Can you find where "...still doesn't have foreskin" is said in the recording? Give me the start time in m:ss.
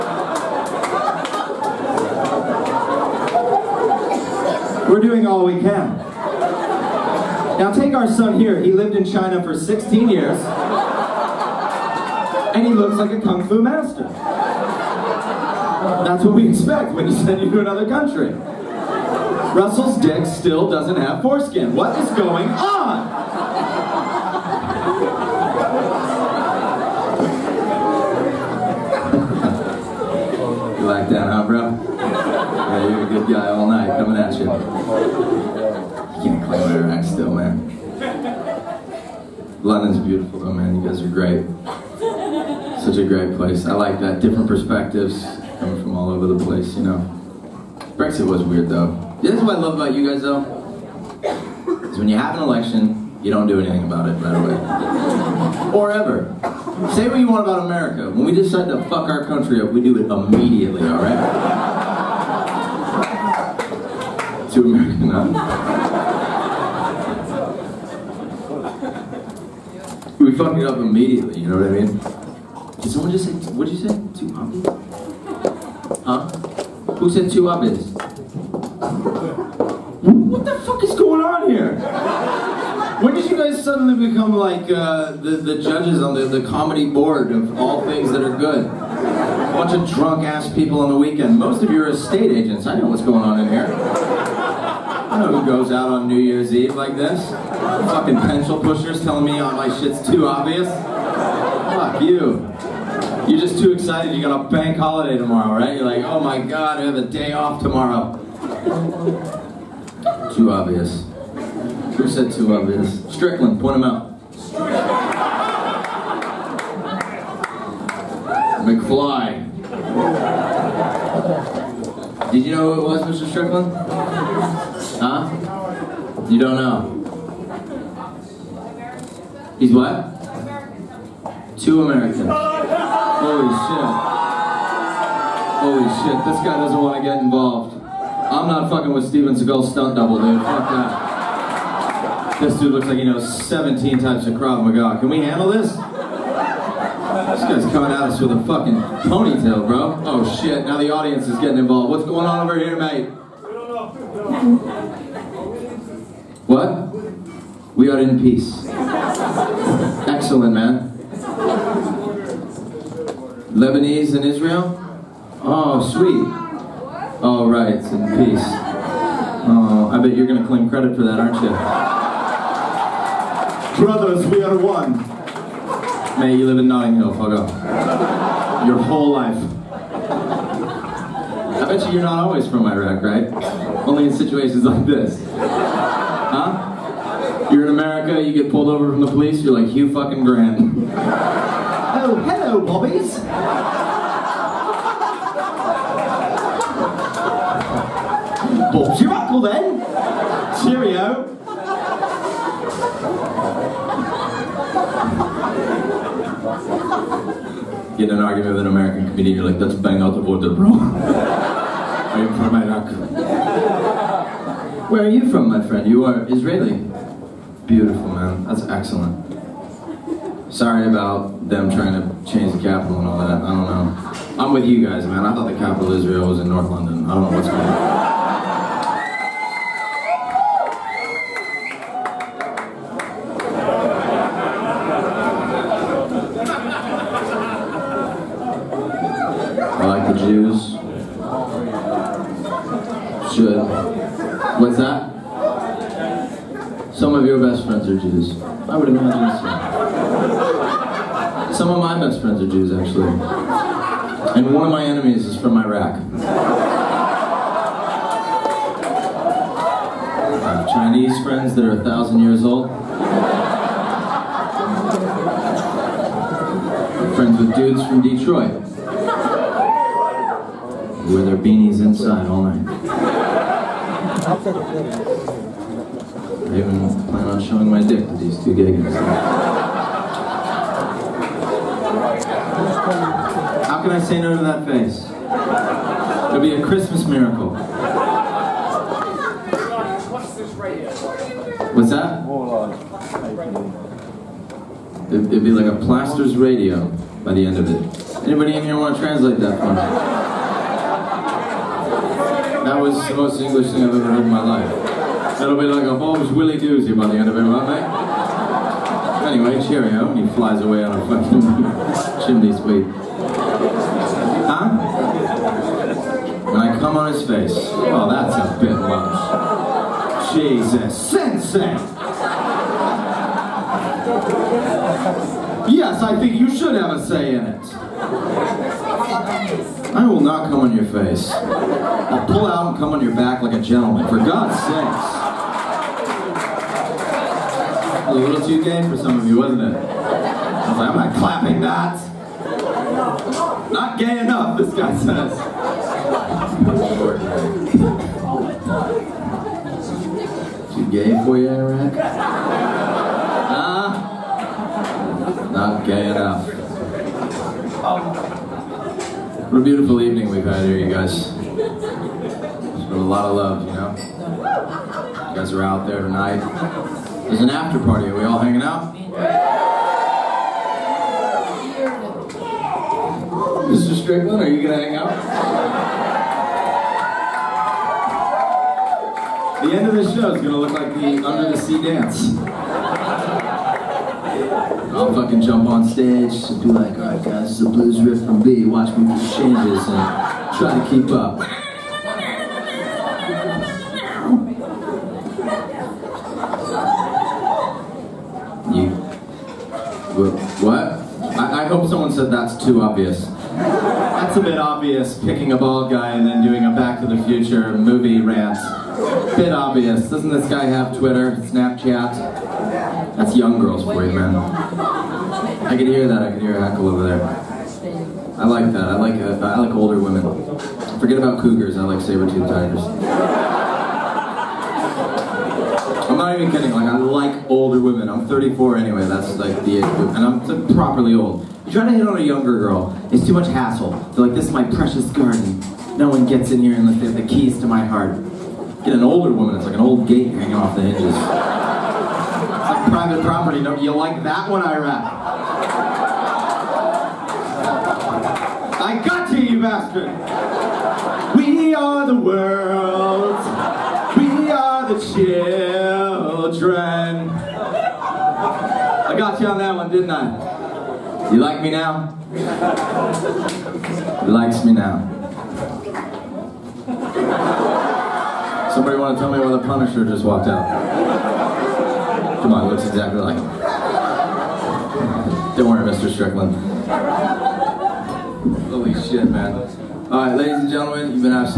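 0:20.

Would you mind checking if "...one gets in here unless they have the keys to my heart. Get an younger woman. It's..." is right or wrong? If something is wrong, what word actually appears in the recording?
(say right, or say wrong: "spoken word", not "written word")
wrong: "older", not "younger".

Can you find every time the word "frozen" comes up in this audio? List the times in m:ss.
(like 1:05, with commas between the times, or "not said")
not said.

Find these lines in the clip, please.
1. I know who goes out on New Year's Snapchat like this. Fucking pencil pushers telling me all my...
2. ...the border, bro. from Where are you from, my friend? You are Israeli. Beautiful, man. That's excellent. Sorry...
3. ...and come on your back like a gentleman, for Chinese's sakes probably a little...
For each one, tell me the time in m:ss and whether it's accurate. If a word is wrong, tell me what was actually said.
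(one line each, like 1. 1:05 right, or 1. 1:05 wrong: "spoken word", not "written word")
1. 1:35 wrong: "Eve", not "Snapchat"
2. 3:30 right
3. 5:32 wrong: "God", not "Chinese".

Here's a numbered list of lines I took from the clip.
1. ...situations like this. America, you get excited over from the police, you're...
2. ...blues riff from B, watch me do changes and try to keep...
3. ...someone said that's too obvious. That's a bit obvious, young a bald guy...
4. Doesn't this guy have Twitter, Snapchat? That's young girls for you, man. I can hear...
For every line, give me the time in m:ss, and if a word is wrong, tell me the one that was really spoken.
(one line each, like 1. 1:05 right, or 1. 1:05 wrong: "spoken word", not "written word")
1. 3:04 wrong: "pulled", not "excited"
2. 6:27 right
3. 6:41 wrong: "picking", not "young"
4. 6:50 right.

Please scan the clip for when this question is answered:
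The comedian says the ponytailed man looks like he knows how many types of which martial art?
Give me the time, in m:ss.
2:23.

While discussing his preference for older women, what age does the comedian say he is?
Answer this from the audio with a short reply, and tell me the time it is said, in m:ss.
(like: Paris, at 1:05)
34, at 7:08.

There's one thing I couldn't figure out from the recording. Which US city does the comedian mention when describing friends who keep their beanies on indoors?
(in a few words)
Detroit.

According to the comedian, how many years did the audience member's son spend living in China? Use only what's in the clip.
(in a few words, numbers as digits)
16.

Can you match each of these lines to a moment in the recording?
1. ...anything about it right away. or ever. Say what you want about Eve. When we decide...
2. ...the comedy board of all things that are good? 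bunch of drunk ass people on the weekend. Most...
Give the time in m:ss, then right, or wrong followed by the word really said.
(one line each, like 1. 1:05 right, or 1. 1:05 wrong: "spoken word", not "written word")
1. 0:53 wrong: "America", not "Eve"
2. 1:26 right.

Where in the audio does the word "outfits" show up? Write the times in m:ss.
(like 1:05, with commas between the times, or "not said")
not said.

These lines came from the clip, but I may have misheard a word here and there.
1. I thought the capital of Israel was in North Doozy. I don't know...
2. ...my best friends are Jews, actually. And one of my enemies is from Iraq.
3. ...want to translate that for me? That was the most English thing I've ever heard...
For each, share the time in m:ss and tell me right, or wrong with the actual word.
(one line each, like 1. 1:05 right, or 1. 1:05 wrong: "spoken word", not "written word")
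1. 3:45 wrong: "London", not "Doozy"
2. 4:11 right
3. 4:58 right.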